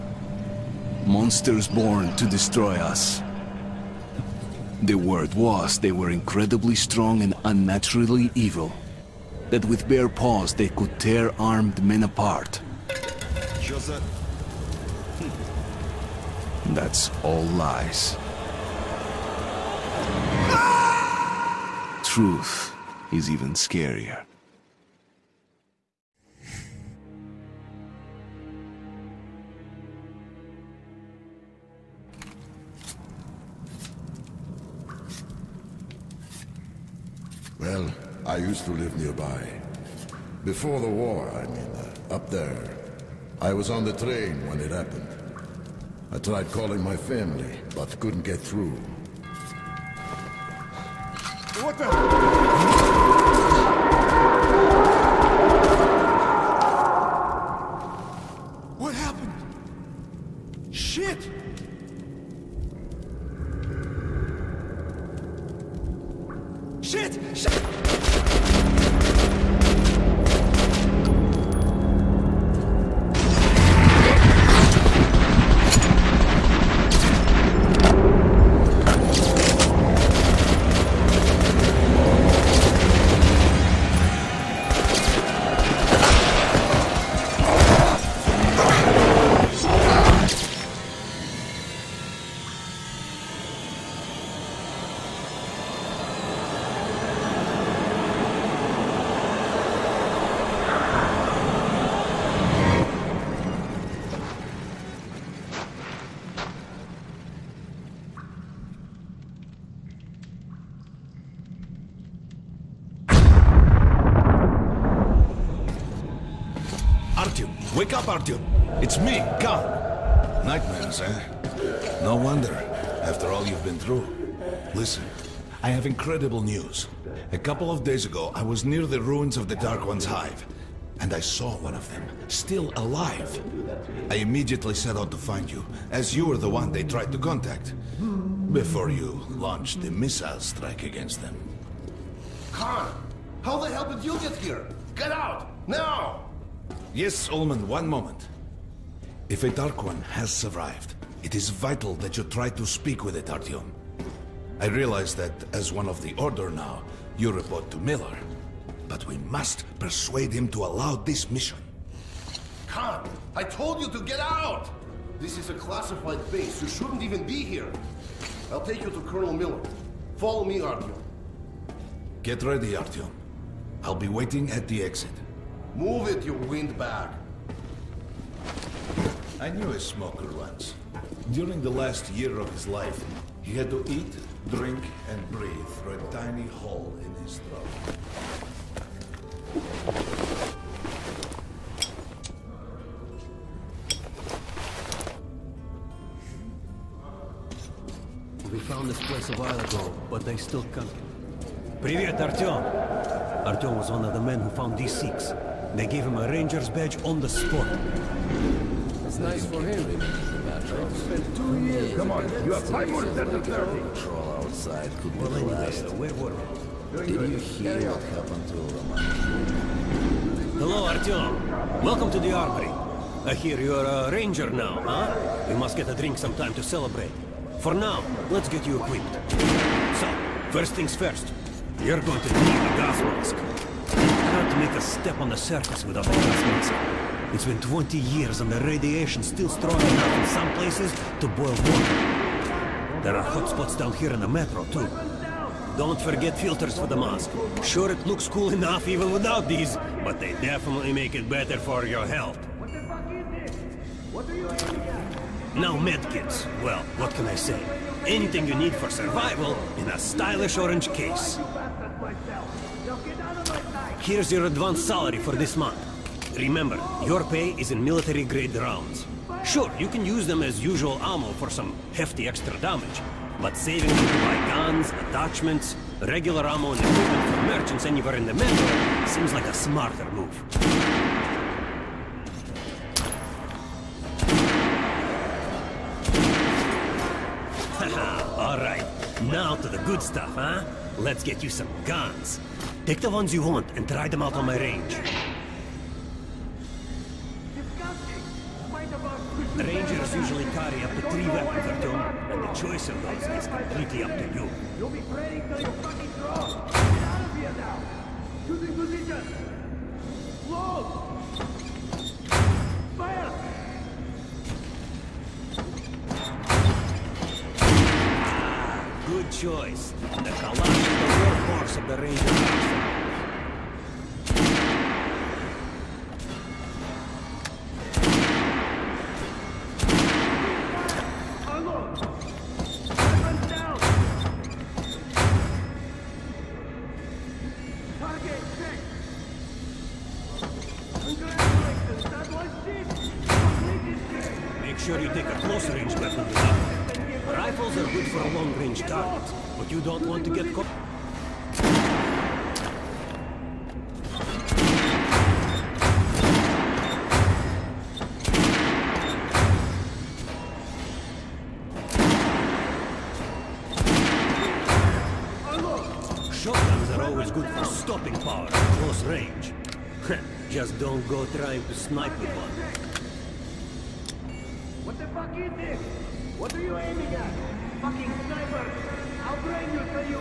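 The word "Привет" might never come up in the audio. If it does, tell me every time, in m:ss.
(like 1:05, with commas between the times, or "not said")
3:21.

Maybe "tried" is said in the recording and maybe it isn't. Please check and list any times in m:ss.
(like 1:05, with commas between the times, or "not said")
0:46, 2:16.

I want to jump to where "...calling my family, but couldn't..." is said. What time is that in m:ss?
0:46.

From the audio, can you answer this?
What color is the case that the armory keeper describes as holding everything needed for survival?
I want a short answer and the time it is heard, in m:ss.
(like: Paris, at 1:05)
Orange, at 4:20.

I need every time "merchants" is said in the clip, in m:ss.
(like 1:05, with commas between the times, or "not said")
4:37.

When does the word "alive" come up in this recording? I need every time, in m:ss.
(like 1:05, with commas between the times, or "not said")
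2:12.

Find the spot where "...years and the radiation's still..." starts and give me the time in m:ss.
3:57.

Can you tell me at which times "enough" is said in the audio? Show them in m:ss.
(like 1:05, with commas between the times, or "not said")
3:59, 4:08.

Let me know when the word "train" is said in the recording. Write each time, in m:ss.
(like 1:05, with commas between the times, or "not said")
0:43, 6:19.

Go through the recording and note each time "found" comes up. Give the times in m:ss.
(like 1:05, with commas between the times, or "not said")
3:18, 3:24.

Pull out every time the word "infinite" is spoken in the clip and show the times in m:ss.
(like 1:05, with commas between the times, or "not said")
not said.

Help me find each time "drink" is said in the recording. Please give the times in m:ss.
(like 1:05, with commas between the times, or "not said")
3:04, 3:45.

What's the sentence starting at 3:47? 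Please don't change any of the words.
For now, let's get you equipped.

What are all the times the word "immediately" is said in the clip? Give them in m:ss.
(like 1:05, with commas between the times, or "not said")
2:14.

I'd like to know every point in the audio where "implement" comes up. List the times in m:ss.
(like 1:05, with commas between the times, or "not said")
not said.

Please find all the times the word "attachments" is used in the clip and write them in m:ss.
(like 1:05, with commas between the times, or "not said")
4:35.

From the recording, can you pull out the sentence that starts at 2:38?
But we must persuade him to allow this mission.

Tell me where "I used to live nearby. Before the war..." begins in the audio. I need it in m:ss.
0:38.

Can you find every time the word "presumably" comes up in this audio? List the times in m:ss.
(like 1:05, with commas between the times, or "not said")
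not said.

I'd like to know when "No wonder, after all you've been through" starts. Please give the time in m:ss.
2:02.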